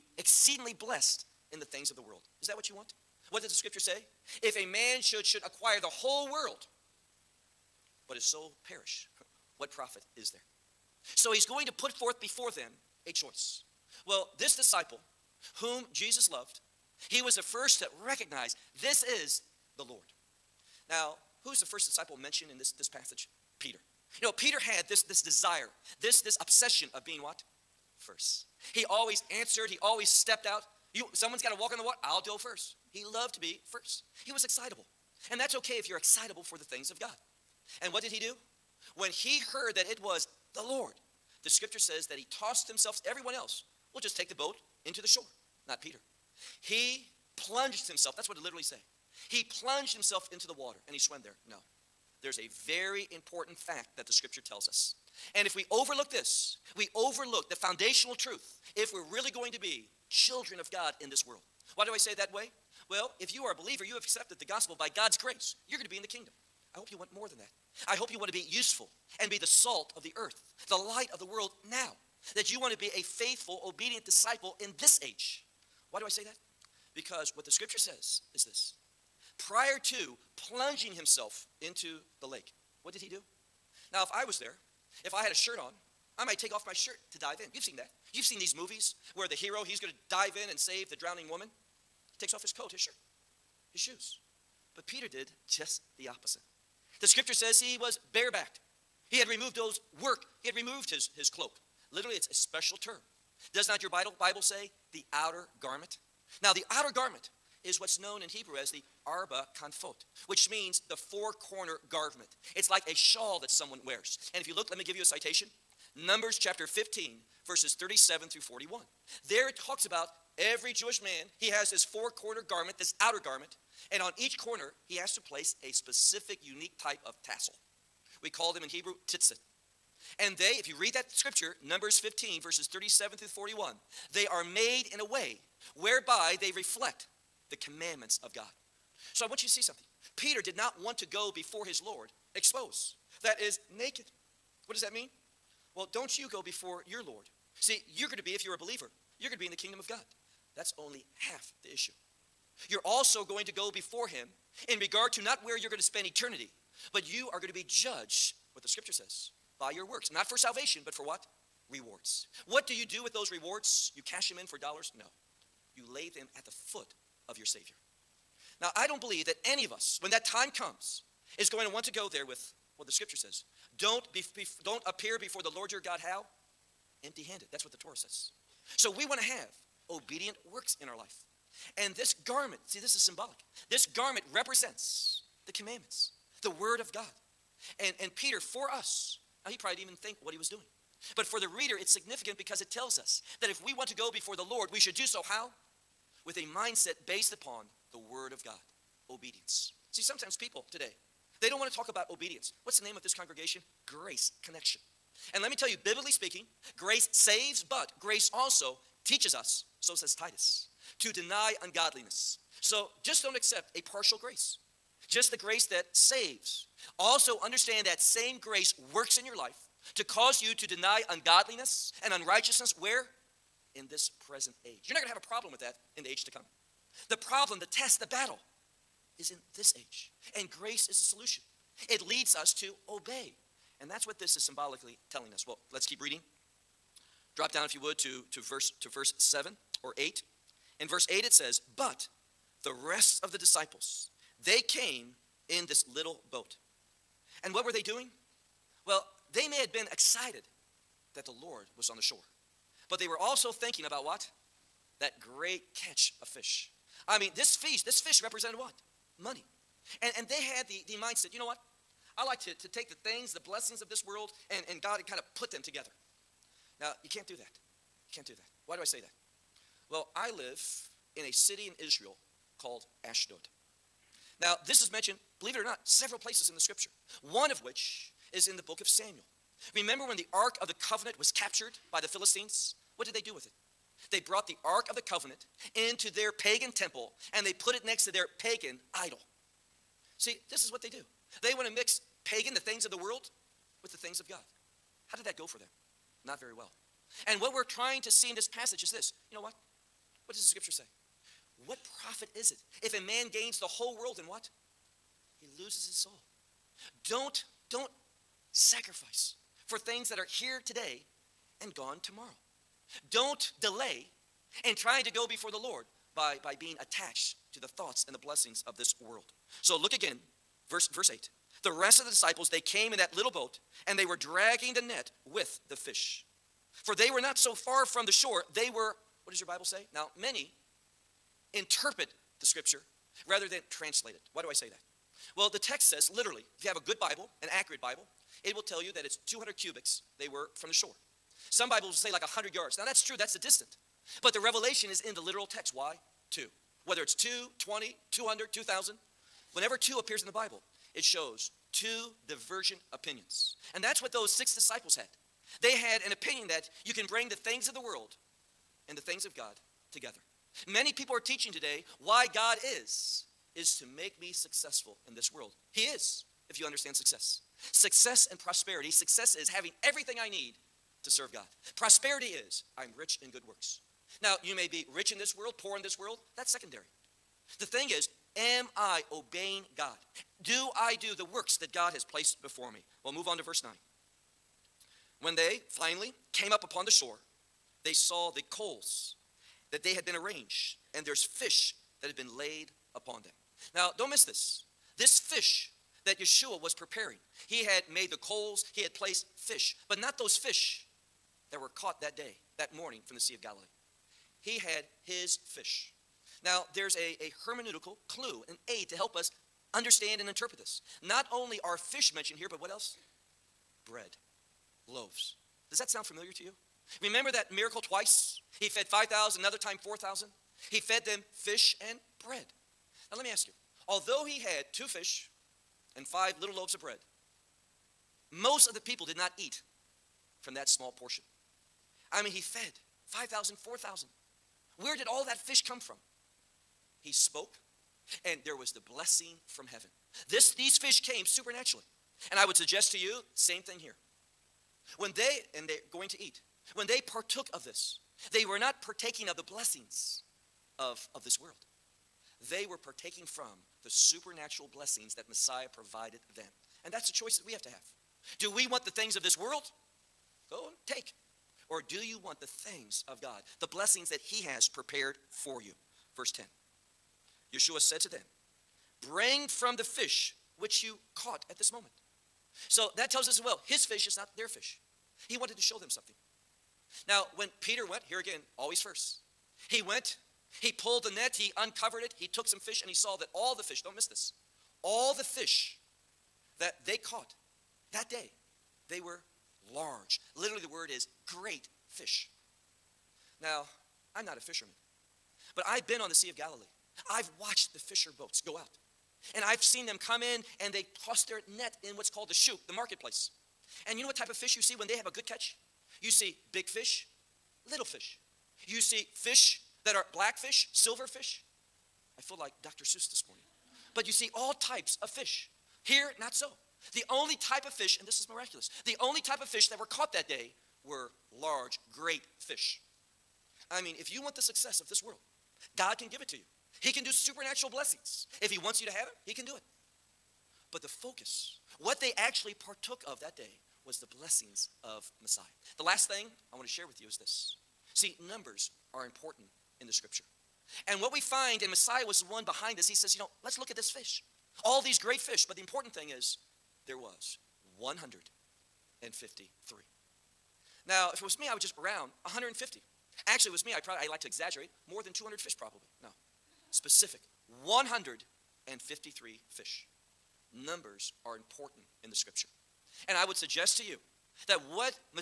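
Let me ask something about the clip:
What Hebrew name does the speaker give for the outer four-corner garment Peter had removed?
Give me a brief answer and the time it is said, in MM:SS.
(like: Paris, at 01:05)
arba kanfot, at 01:49.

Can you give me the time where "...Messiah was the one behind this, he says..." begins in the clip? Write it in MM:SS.
09:01.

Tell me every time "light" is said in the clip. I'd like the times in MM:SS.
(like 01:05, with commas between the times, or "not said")
01:10.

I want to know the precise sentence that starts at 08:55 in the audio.
The last thing I want to share with you is this.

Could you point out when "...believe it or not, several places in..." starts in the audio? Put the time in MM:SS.
04:35.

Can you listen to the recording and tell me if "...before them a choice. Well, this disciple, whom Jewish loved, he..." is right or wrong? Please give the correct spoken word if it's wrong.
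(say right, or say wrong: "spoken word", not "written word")
wrong: "Jesus", not "Jewish".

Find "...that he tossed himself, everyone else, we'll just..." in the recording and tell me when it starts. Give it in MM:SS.
00:42.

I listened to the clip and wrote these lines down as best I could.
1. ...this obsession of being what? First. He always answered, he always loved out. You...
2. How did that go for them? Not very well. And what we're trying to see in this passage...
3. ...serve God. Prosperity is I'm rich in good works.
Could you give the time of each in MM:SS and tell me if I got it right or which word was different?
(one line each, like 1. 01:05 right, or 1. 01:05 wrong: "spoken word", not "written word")
1. 00:26 wrong: "stepped", not "loved"
2. 04:55 right
3. 06:11 right.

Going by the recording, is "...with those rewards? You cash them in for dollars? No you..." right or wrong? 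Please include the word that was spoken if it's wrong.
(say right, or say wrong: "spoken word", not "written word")
right.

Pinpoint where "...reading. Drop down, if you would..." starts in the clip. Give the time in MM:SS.
03:56.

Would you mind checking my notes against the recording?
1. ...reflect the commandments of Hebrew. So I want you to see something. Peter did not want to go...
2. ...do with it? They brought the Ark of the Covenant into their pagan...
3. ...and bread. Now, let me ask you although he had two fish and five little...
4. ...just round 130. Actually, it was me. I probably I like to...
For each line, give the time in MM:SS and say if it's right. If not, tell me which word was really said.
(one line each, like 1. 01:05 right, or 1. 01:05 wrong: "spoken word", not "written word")
1. 02:16 wrong: "God", not "Hebrew"
2. 04:43 right
3. 07:01 right
4. 09:11 wrong: "150", not "130".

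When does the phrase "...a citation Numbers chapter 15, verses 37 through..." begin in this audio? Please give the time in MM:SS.
01:55.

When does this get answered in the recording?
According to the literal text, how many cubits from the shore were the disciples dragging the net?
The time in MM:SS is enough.
05:39.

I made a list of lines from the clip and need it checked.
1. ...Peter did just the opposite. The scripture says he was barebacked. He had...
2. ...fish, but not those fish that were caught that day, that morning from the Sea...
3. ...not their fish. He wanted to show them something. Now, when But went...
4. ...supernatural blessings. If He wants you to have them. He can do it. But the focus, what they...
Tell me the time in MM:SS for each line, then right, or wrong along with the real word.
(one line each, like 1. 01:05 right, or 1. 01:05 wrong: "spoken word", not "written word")
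1. 01:34 right
2. 06:39 right
3. 07:54 wrong: "Peter", not "But"
4. 08:47 right.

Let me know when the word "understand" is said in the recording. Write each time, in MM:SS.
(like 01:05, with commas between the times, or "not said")
03:37, 06:06, 06:49.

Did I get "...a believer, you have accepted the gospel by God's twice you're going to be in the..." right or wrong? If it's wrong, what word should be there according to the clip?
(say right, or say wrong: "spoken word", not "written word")
wrong: "grace", not "twice".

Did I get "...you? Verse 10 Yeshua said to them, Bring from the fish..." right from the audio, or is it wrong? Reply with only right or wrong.
right.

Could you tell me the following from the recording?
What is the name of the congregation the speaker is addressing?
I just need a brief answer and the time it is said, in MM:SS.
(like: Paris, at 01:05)
Grace Connection, at 03:23.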